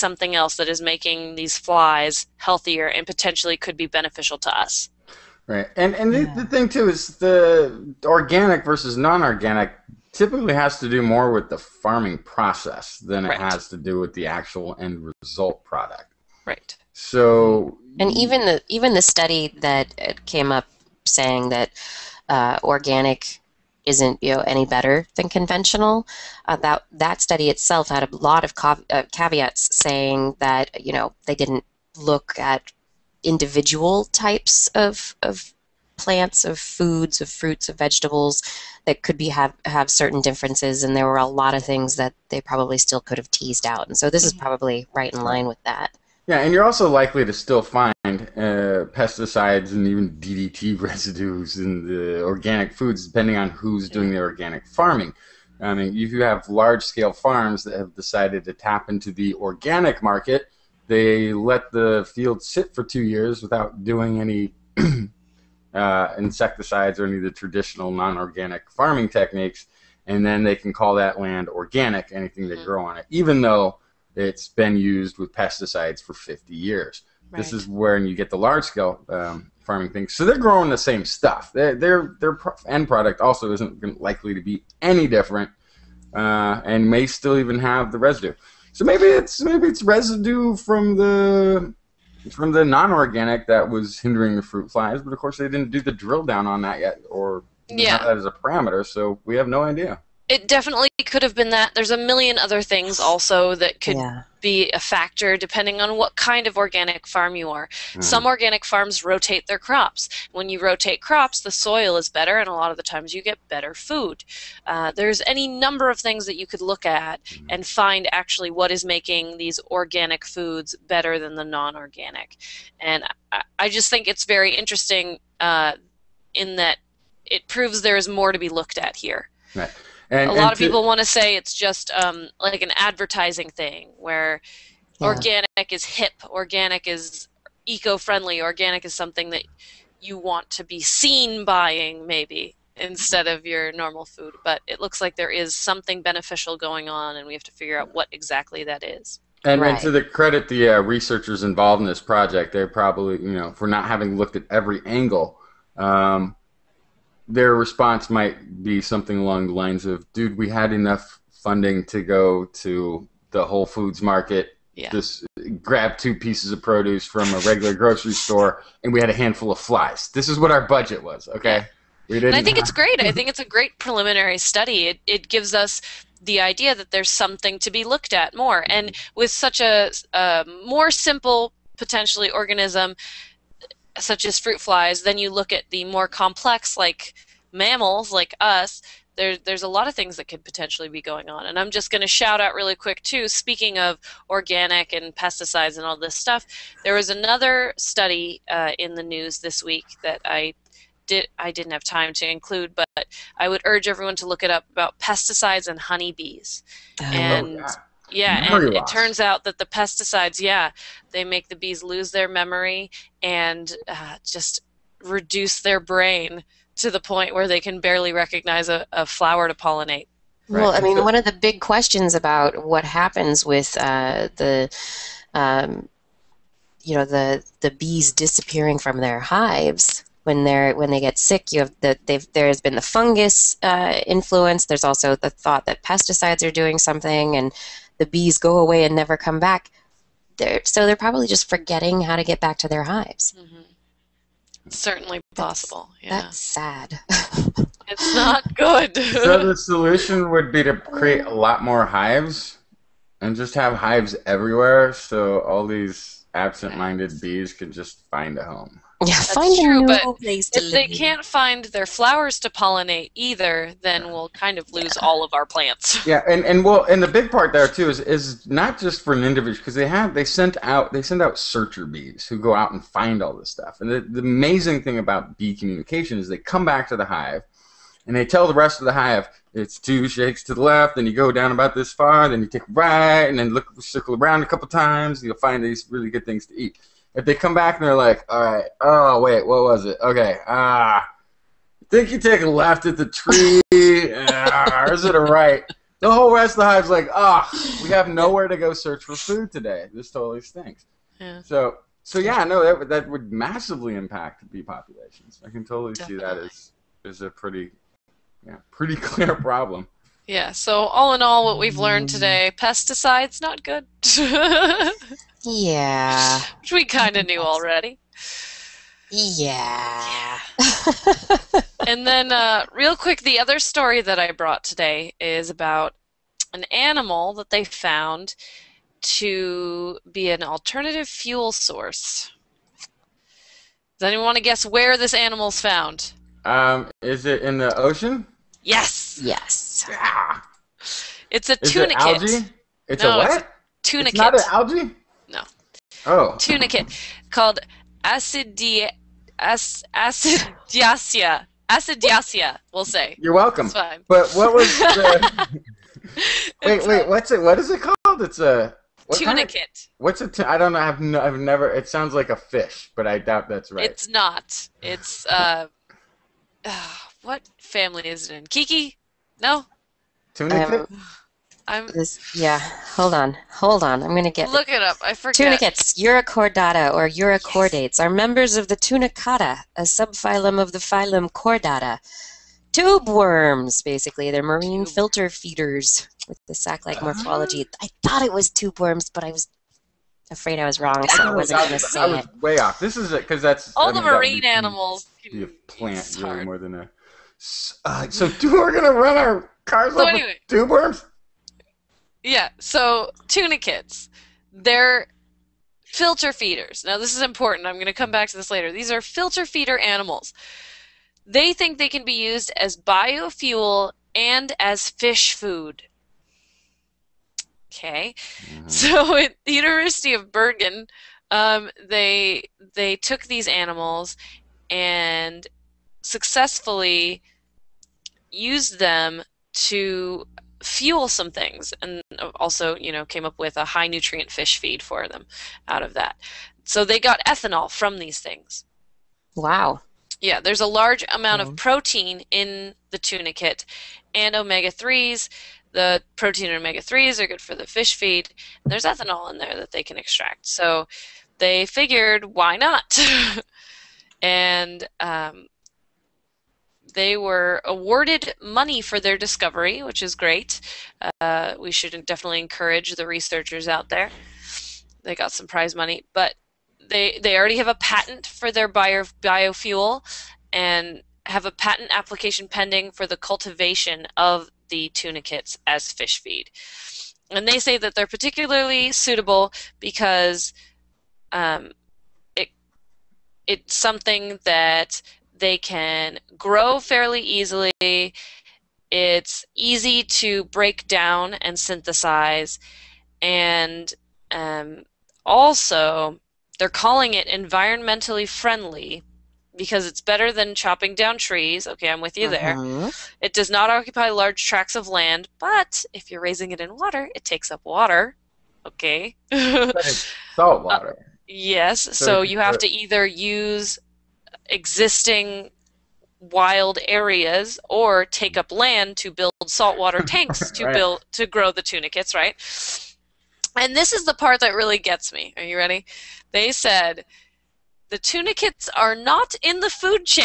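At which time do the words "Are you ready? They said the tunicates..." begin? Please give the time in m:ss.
8:45.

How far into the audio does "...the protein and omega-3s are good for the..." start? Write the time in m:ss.
7:25.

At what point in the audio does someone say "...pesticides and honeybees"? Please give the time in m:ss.
3:24.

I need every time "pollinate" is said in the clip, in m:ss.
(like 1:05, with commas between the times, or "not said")
3:39, 4:22.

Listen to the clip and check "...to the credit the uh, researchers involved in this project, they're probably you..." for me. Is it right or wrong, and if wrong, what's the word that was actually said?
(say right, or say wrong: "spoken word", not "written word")
right.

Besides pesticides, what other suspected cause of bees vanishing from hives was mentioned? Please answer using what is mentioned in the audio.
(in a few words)
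fungus.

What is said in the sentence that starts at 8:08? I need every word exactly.
It's easy to break down and synthesize.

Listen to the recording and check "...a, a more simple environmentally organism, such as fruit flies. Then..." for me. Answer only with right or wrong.
wrong.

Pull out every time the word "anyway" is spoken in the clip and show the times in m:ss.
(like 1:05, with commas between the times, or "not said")
6:40.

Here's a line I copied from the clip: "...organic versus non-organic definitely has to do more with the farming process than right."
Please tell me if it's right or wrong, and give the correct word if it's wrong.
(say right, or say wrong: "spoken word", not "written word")
wrong: "typically", not "definitely".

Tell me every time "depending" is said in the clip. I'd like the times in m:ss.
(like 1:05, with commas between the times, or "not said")
0:53, 1:45.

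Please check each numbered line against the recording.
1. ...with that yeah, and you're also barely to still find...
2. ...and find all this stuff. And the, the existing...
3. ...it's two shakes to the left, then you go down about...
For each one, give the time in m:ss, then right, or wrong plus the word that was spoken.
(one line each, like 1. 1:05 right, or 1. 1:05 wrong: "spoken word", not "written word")
1. 0:45 wrong: "likely", not "barely"
2. 4:32 wrong: "amazing", not "existing"
3. 4:39 right.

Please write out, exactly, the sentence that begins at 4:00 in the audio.
They're, so they're probably just forgetting how to get back to their hives.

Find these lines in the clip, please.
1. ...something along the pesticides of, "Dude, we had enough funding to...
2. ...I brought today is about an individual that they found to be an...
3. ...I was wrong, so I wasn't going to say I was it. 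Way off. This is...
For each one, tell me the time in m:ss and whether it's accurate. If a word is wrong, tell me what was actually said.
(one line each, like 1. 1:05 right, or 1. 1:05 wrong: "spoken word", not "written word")
1. 2:38 wrong: "lines", not "pesticides"
2. 5:24 wrong: "animal", not "individual"
3. 6:30 right.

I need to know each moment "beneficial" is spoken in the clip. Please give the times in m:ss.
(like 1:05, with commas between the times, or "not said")
0:03, 2:26.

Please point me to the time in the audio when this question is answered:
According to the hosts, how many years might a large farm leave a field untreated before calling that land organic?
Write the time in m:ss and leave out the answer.
1:02.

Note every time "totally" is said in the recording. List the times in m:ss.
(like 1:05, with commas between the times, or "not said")
5:00, 5:05.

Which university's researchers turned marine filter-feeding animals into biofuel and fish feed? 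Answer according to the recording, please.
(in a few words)
University of Bergen.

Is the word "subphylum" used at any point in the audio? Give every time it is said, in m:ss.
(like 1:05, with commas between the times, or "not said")
6:19.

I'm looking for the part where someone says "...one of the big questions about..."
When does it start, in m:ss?
3:41.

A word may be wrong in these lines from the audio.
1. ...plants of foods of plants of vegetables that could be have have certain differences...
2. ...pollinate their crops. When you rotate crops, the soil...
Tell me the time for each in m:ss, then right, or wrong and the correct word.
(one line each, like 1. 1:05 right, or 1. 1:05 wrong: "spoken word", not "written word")
1. 0:35 wrong: "fruits", not "plants"
2. 1:49 wrong: "rotate", not "pollinate".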